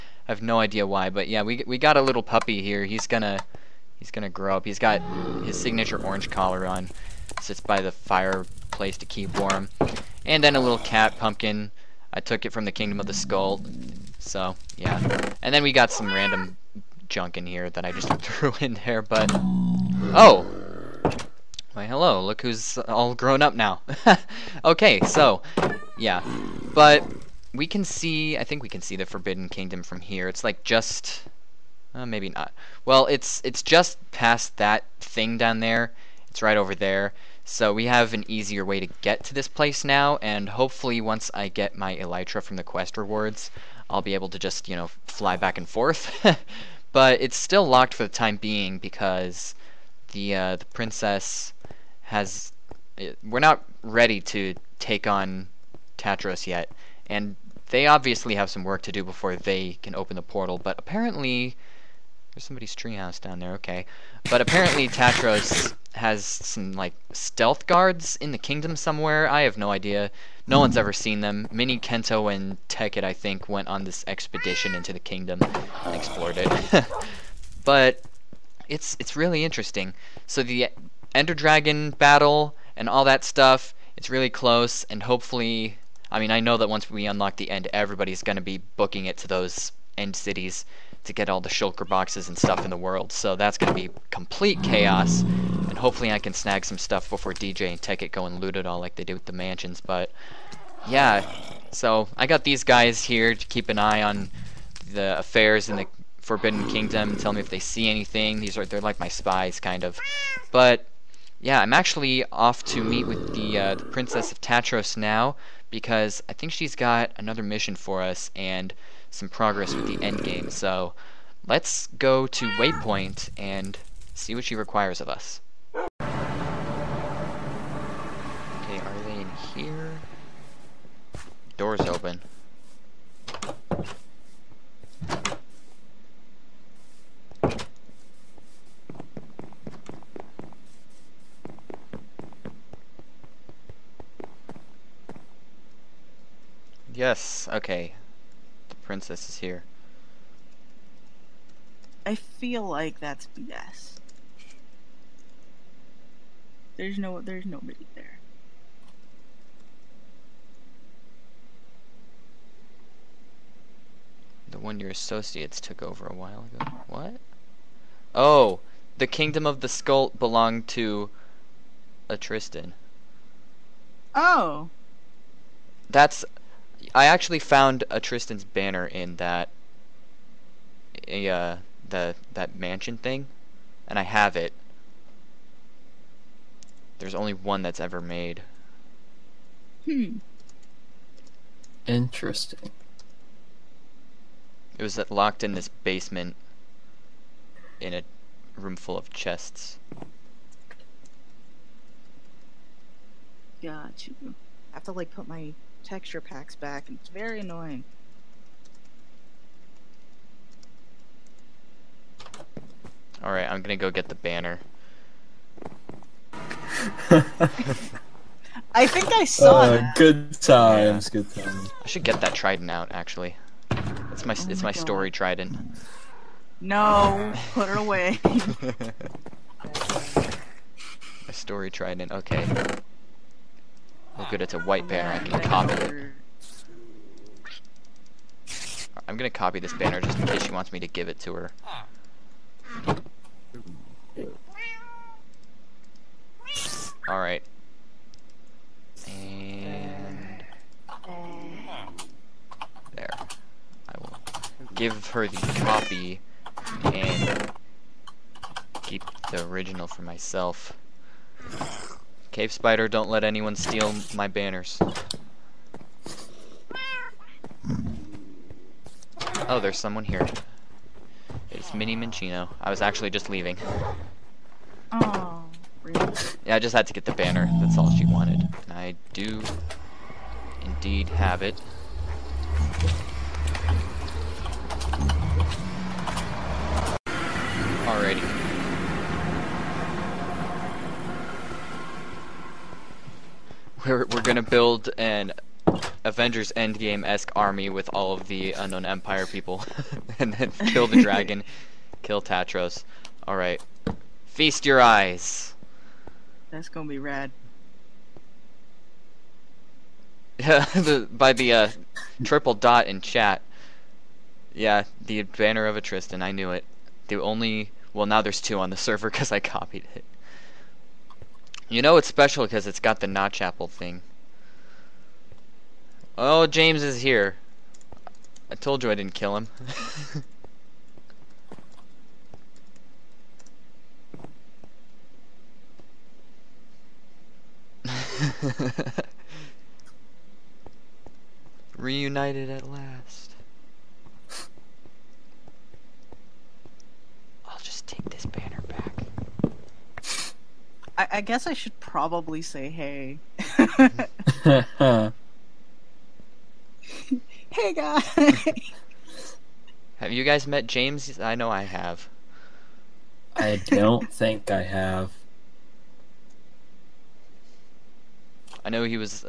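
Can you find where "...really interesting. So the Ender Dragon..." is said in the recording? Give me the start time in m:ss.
1:19.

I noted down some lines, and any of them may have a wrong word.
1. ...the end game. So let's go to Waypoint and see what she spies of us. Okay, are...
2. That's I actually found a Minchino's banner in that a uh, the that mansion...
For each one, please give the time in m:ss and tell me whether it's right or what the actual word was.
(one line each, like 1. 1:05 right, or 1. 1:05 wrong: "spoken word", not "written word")
1. 1:59 wrong: "requires", not "spies"
2. 2:55 wrong: "Tristan", not "Minchino".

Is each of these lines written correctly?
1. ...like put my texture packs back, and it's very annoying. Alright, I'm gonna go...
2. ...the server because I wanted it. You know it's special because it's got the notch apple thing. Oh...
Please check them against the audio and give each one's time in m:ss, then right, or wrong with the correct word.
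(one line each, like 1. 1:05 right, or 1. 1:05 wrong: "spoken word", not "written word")
1. 3:24 right
2. 5:18 wrong: "copied", not "wanted".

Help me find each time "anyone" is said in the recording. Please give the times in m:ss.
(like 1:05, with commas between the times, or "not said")
4:23.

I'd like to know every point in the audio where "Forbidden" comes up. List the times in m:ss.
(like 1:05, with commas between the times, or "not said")
0:29, 1:46.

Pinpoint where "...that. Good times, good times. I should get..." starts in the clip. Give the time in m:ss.
3:39.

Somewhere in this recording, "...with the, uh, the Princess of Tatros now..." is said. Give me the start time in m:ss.
1:53.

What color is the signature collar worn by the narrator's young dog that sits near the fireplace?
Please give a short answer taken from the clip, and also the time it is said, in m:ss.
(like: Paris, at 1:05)
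Orange, at 0:06.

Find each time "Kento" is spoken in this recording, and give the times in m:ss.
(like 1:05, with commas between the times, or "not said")
1:11.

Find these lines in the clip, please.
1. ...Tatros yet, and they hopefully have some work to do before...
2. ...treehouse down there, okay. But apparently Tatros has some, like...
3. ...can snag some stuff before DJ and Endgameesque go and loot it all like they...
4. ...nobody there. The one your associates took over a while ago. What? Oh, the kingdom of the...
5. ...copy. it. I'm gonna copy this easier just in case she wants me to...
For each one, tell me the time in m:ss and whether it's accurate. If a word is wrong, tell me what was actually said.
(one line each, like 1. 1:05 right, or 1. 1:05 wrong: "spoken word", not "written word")
1. 0:55 wrong: "obviously", not "hopefully"
2. 1:02 right
3. 1:36 wrong: "Tekkit", not "Endgameesque"
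4. 2:37 right
5. 3:55 wrong: "banner", not "easier".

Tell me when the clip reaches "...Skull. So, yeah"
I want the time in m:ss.
0:13.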